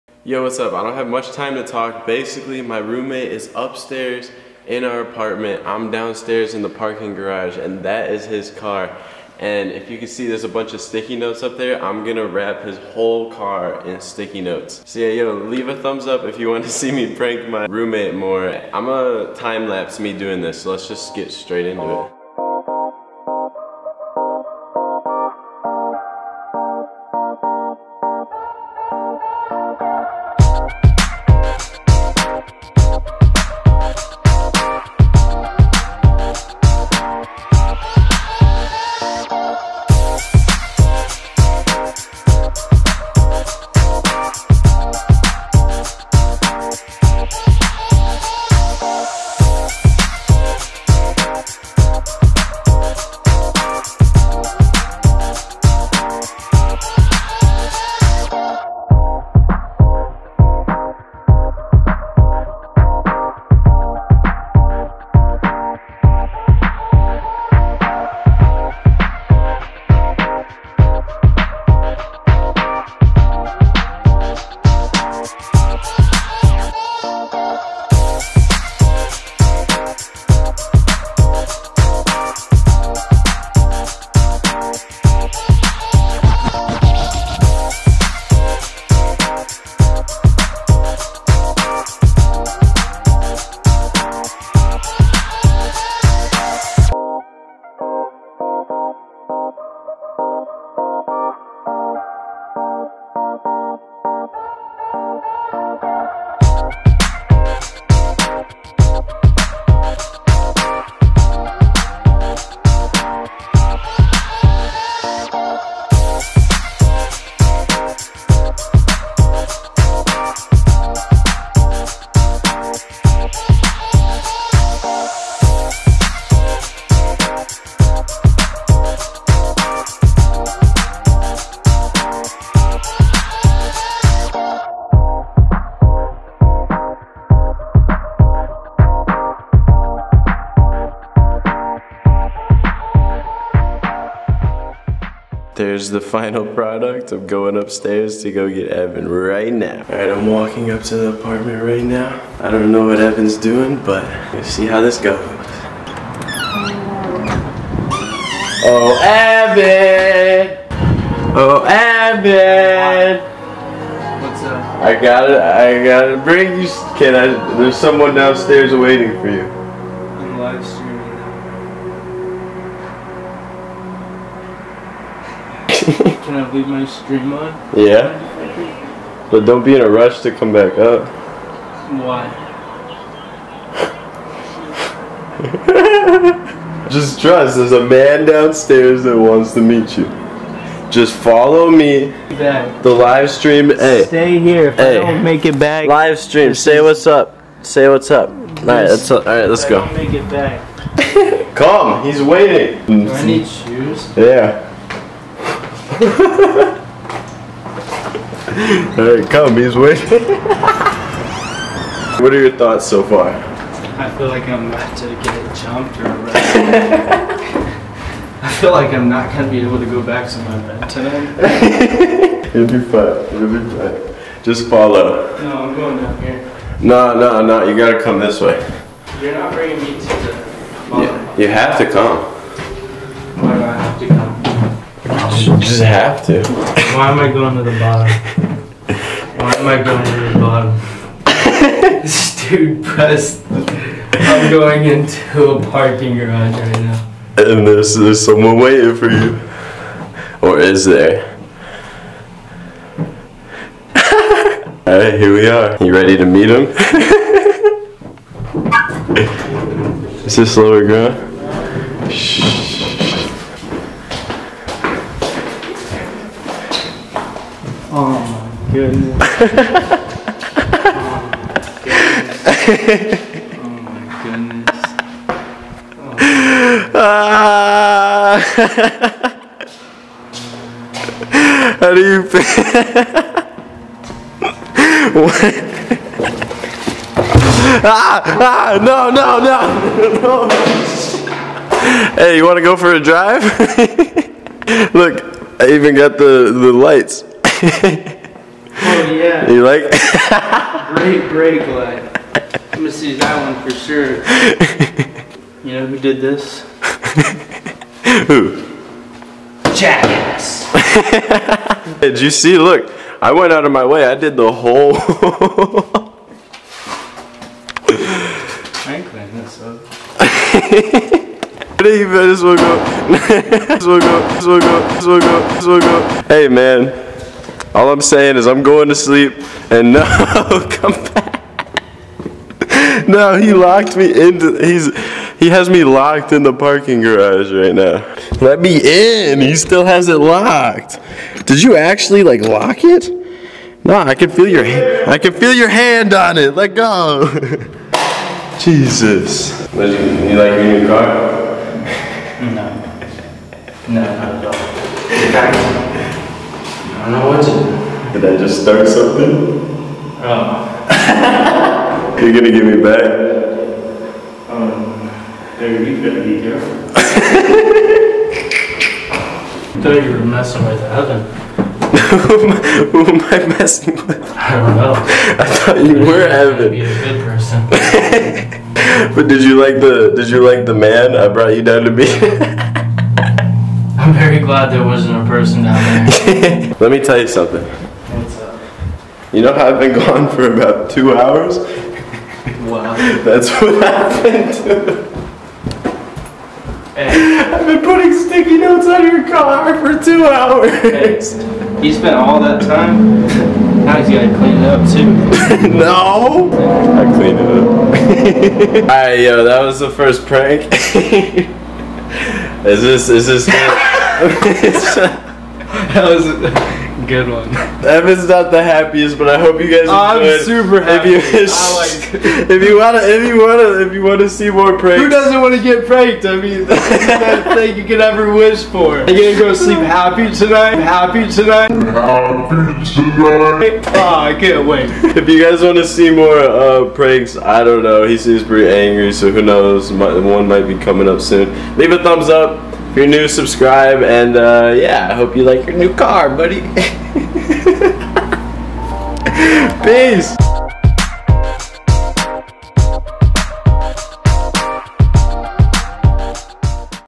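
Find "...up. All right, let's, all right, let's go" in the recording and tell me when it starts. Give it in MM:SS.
03:18.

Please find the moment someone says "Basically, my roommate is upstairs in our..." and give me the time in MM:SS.
00:02.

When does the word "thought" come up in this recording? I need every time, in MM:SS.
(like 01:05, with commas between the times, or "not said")
03:32, 06:09, 06:15.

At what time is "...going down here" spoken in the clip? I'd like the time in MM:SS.
03:45.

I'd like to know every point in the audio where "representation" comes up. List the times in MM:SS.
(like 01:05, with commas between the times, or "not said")
not said.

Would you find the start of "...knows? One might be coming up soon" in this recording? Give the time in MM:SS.
07:19.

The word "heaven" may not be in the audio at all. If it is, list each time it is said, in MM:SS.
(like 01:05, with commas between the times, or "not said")
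06:10.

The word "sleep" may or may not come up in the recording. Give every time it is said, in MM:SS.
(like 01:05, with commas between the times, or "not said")
05:28, 07:09.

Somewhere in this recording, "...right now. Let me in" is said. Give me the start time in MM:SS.
05:37.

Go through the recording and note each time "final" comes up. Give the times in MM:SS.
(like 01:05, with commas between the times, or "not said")
02:25.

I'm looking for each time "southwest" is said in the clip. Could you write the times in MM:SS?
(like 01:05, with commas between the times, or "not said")
not said.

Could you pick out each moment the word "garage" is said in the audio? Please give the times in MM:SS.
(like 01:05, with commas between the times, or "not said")
00:07, 04:06, 05:37.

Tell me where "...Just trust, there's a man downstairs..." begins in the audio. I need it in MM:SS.
03:06.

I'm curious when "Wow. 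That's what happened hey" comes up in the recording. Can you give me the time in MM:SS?
06:32.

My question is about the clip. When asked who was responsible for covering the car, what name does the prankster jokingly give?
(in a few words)
Jackass.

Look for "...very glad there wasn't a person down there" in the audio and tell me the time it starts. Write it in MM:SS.
06:24.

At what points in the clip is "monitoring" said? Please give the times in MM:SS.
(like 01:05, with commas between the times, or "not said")
not said.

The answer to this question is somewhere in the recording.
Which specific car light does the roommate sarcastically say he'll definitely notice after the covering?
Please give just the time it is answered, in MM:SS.
05:01.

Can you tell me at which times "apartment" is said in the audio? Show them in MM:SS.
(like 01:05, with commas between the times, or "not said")
00:05, 02:31.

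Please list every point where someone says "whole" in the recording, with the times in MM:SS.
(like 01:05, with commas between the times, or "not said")
00:12, 05:14.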